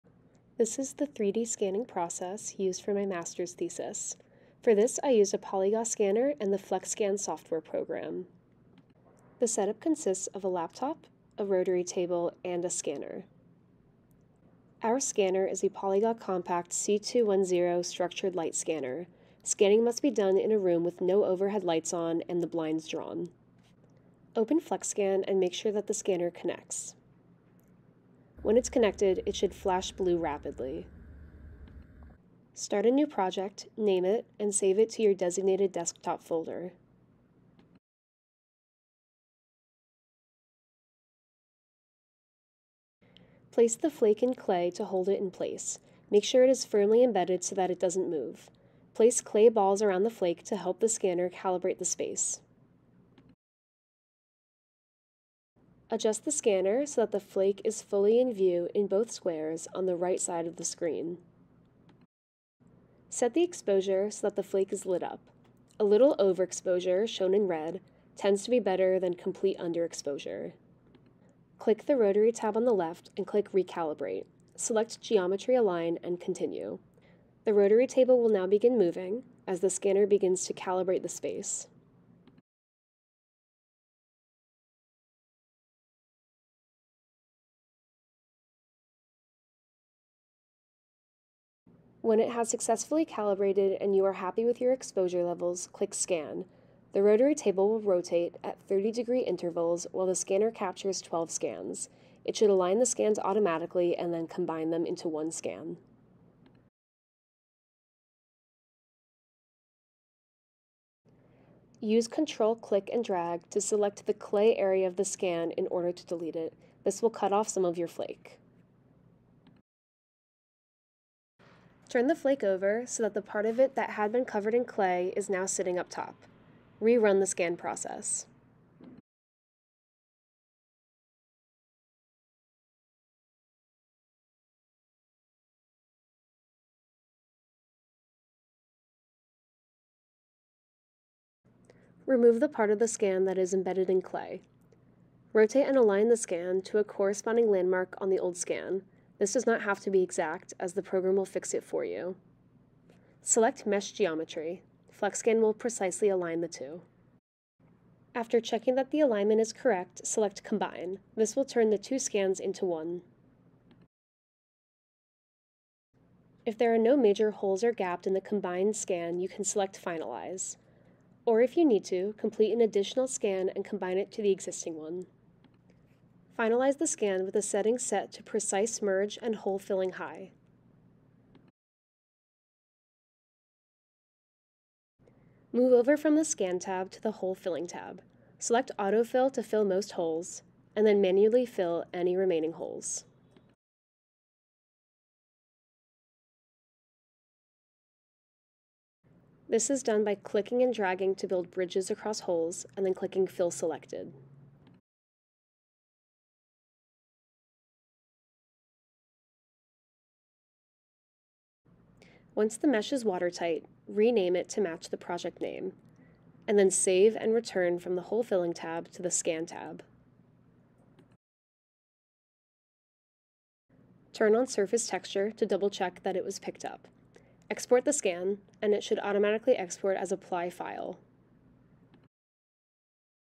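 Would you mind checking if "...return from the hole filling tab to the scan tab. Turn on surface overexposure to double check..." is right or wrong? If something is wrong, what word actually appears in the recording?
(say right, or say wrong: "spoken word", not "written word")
wrong: "texture", not "overexposure".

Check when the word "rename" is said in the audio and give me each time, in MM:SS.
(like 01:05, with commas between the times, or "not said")
03:33.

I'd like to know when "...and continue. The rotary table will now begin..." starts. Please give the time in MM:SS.
01:16.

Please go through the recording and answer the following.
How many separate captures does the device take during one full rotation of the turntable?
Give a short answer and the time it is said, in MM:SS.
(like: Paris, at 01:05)
12, at 01:40.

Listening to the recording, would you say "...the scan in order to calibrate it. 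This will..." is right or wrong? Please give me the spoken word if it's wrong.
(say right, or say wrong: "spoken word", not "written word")
wrong: "delete", not "calibrate".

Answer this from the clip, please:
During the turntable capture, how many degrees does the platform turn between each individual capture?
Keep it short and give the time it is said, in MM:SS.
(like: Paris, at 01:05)
30 degrees, at 01:38.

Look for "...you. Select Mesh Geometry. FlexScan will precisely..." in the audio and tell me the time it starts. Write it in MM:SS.
02:31.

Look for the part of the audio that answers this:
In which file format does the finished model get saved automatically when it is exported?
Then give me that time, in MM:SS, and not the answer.
03:50.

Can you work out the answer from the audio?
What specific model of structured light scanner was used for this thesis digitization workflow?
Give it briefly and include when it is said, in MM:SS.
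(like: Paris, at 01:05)
Polyga Compact C210, at 00:15.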